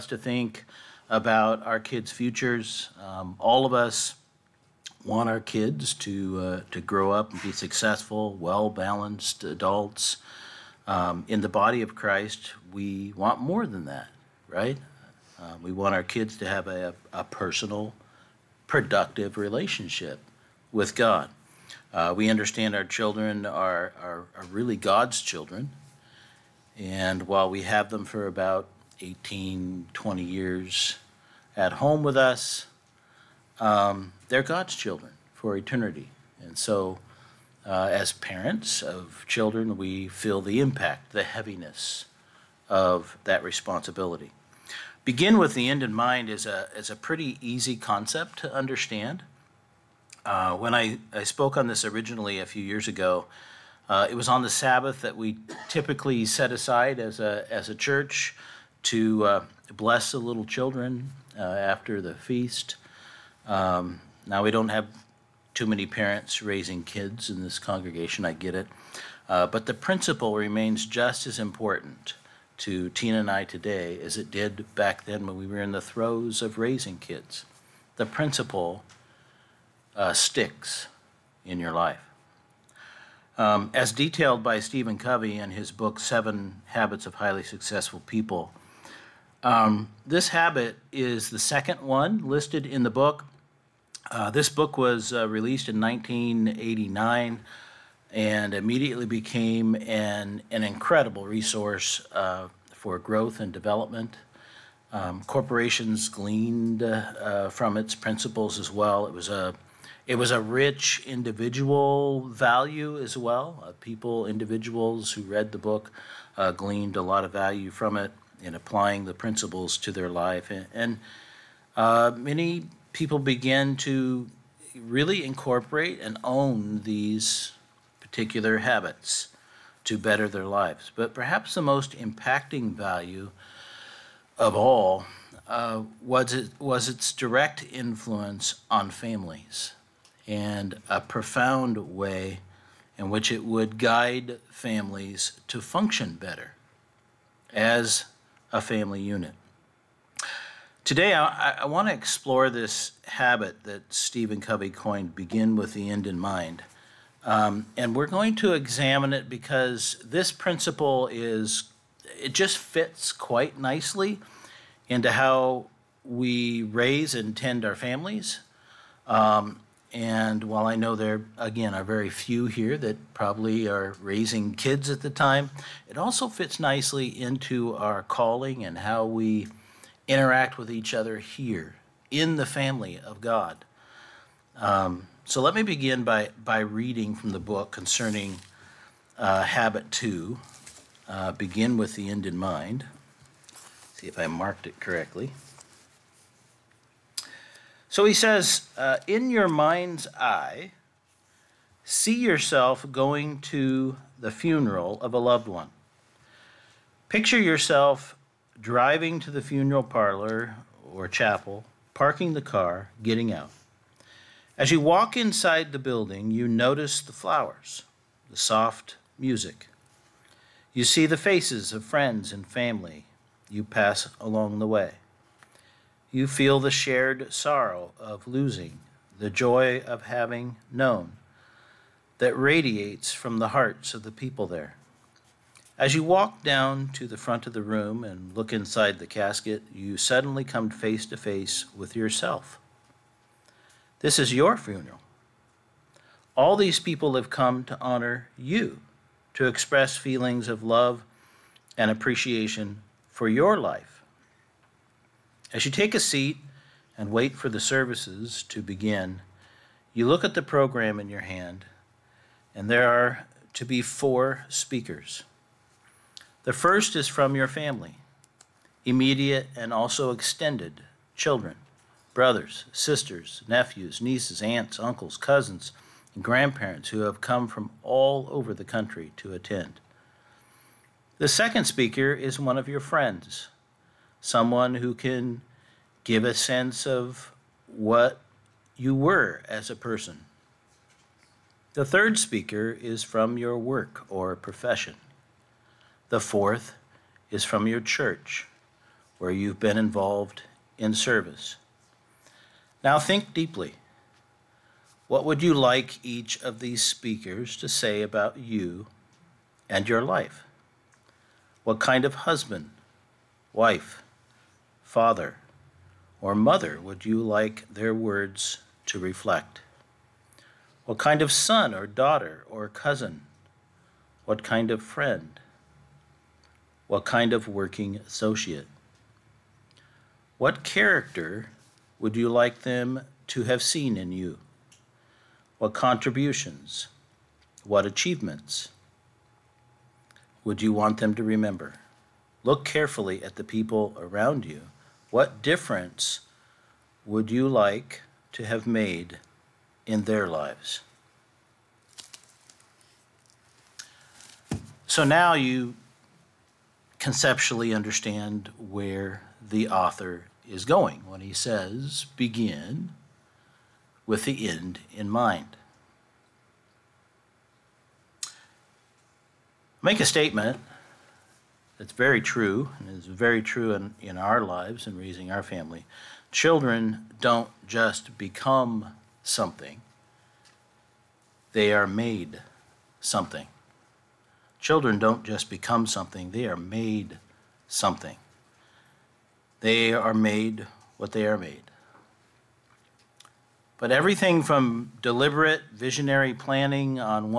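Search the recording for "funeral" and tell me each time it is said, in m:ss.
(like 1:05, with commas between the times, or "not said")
3:24, 3:29, 4:04.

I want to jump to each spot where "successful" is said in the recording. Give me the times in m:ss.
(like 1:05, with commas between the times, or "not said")
0:07, 1:27.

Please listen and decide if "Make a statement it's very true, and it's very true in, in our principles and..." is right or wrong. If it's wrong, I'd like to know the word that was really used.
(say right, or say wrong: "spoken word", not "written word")
wrong: "lives", not "principles".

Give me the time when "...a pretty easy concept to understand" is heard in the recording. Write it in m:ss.
0:46.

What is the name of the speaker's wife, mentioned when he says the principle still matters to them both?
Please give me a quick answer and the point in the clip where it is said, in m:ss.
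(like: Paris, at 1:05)
Tina, at 1:12.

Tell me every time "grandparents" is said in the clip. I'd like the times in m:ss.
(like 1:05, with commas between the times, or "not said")
4:36.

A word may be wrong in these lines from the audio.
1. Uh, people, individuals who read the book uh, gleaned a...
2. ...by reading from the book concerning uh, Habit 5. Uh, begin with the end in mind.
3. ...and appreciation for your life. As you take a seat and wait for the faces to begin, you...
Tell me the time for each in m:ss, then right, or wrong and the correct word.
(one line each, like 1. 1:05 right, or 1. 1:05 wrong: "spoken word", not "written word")
1. 1:53 right
2. 3:06 wrong: "2", not "5"
3. 4:11 wrong: "services", not "faces".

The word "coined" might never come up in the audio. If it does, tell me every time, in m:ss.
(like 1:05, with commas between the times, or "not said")
2:34.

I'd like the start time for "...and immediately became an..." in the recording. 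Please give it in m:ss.
1:38.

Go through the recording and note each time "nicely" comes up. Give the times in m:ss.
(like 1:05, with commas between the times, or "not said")
2:43, 2:56.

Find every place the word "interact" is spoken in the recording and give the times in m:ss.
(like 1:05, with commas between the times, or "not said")
3:00.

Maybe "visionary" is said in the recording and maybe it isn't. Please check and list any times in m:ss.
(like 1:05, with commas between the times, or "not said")
6:35.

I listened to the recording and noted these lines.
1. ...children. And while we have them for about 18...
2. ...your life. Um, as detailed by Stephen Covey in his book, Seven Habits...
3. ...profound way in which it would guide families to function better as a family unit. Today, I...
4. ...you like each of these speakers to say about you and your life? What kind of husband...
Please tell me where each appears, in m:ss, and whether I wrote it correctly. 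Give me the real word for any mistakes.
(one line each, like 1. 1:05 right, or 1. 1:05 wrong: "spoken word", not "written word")
1. 0:25 right
2. 1:21 right
3. 2:21 right
4. 5:05 right.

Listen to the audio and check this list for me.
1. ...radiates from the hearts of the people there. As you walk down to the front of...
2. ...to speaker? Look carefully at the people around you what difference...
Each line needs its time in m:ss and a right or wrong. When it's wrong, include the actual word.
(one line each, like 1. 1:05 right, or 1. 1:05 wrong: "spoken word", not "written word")
1. 3:52 right
2. 5:41 wrong: "remember", not "speaker".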